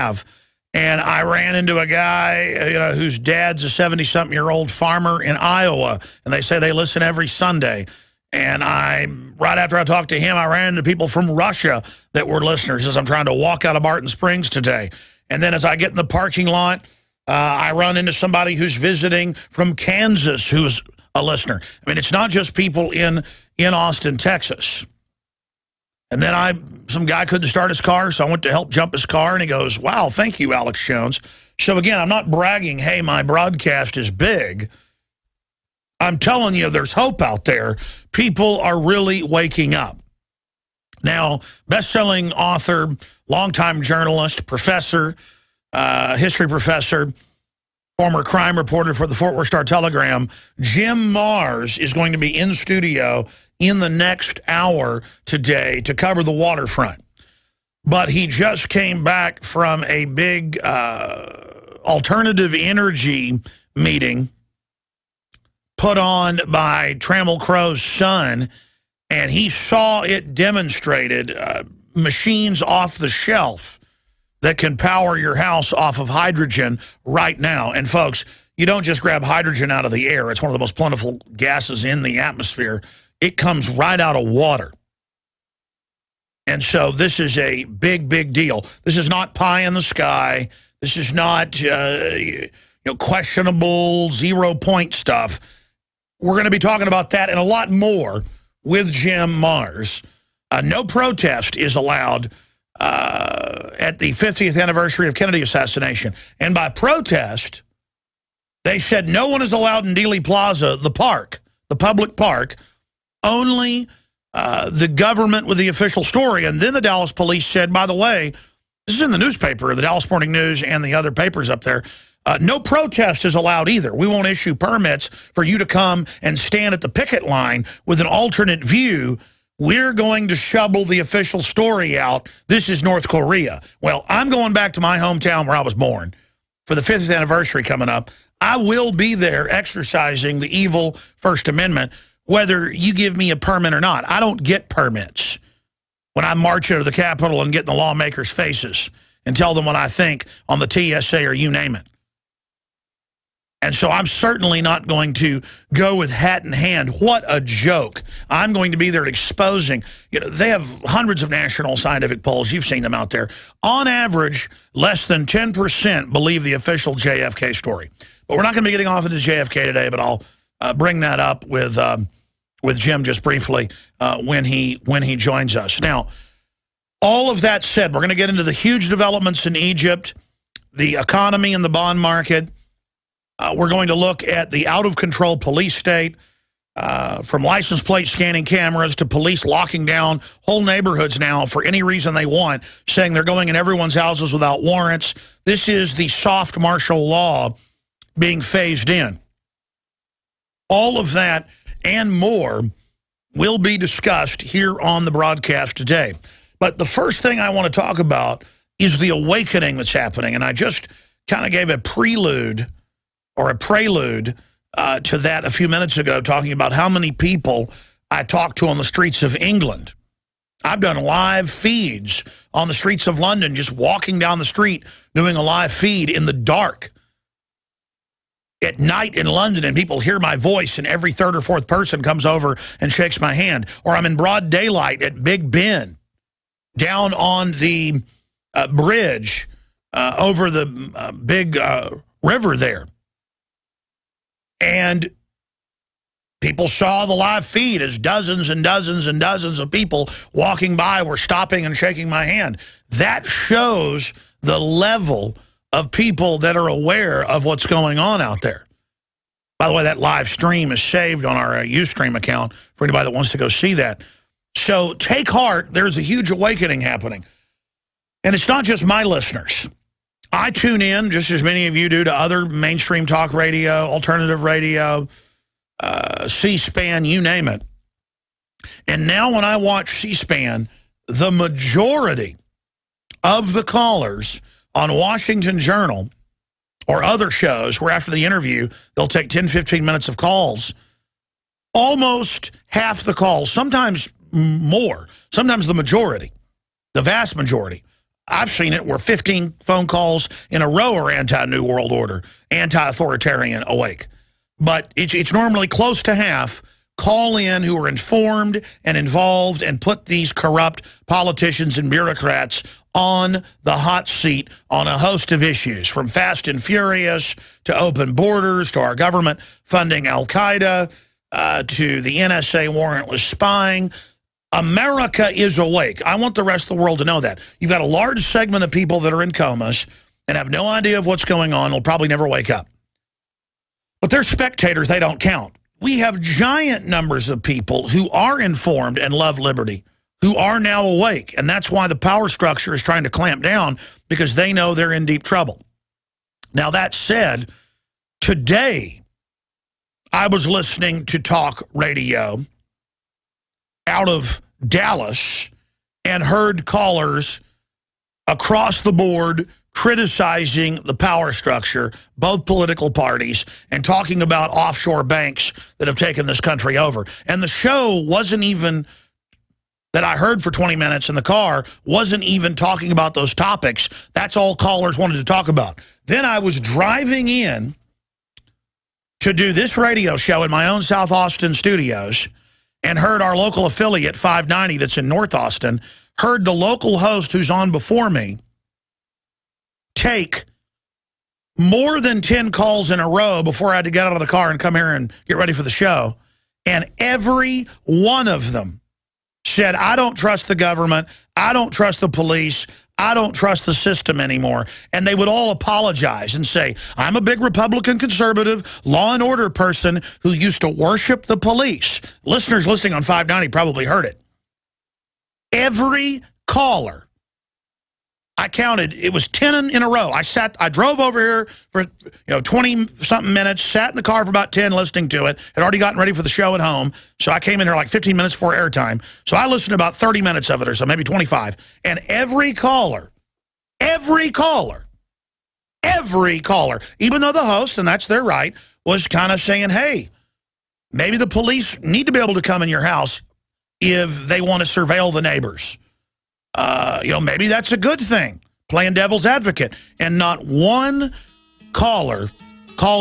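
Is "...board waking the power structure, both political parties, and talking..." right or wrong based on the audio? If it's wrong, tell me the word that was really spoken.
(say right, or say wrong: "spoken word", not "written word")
wrong: "criticizing", not "waking".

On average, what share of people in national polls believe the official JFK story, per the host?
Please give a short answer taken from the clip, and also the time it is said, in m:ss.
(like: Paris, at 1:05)
less than 10%, at 2:44.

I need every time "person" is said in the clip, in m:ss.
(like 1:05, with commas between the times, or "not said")
3:51, 6:49.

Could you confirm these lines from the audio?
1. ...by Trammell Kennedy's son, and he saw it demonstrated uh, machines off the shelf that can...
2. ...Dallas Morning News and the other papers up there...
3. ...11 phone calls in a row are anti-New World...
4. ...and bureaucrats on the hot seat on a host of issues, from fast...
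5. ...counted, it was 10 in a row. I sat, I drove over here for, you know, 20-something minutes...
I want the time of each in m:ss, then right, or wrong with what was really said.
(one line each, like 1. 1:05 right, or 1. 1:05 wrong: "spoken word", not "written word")
1. 1:06 wrong: "Crow", not "Kennedy"
2. 1:59 right
3. 4:58 wrong: "15", not "11"
4. 5:11 right
5. 6:58 right.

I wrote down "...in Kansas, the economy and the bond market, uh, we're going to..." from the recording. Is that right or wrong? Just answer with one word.
wrong.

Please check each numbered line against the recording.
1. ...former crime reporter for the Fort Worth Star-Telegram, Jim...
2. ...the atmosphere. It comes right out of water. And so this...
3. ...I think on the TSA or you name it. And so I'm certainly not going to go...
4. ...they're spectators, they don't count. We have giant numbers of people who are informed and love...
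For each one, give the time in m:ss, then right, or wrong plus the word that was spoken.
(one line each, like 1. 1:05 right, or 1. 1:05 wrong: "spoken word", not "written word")
1. 0:47 right
2. 1:22 right
3. 2:29 right
4. 5:34 right.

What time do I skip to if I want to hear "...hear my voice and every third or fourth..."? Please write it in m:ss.
3:50.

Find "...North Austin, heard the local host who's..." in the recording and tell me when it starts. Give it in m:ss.
6:25.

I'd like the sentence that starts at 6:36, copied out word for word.
And every one of them said, I don't trust the government.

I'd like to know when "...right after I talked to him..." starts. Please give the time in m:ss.
0:09.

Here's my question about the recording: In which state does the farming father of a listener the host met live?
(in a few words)
Iowa.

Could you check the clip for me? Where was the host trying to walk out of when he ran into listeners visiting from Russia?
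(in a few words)
Barton Springs.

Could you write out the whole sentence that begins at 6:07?
And the show wasn't even that I heard for 20 minutes in the car wasn't even talking about those topics.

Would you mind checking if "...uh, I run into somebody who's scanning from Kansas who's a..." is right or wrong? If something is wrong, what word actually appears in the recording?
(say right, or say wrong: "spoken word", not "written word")
wrong: "visiting", not "scanning".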